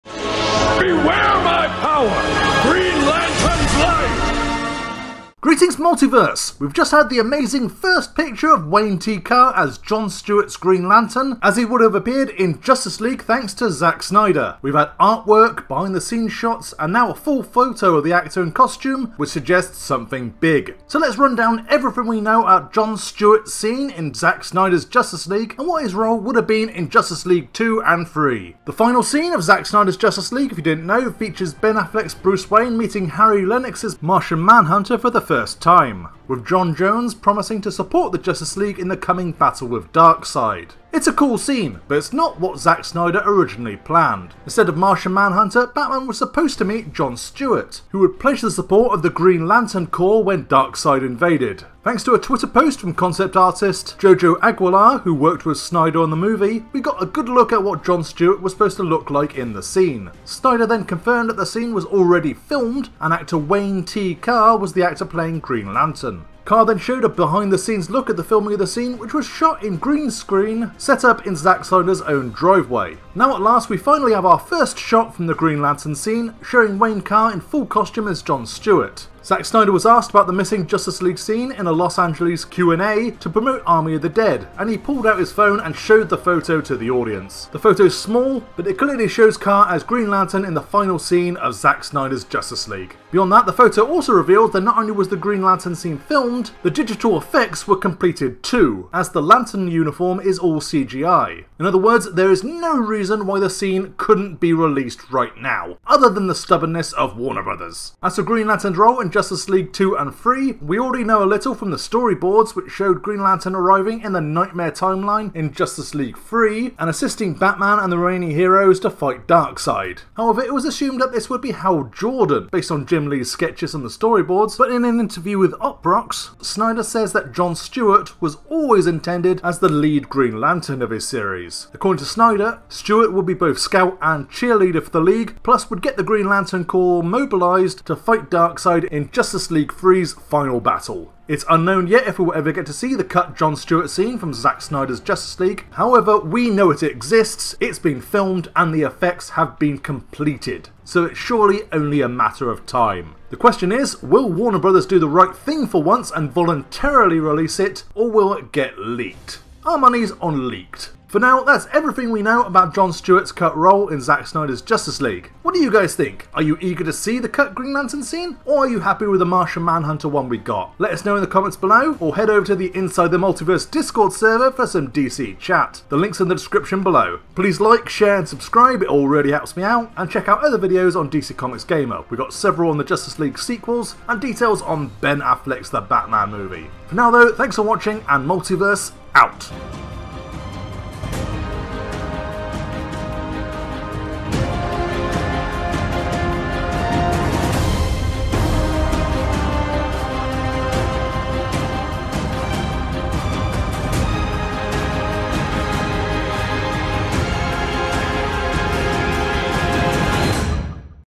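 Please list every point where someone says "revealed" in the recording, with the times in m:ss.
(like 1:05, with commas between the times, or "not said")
1:34.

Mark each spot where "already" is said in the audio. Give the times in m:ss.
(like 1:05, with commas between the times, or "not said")
1:01, 1:50.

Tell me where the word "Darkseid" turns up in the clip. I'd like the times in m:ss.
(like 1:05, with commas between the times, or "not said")
0:39, 0:50, 1:59, 2:18.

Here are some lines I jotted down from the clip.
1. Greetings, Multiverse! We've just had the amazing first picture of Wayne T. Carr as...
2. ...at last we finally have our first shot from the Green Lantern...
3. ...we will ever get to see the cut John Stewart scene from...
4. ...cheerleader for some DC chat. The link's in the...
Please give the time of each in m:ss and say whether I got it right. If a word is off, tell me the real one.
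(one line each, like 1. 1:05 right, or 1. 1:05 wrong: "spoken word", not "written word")
1. 0:05 right
2. 1:13 right
3. 2:22 right
4. 2:54 wrong: "server", not "cheerleader".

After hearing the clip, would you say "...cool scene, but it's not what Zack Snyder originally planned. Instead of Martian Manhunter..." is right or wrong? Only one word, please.
right.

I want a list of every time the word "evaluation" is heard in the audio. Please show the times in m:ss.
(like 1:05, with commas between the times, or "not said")
not said.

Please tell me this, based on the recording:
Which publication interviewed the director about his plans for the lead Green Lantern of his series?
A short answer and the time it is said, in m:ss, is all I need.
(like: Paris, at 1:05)
Uproxx, at 2:05.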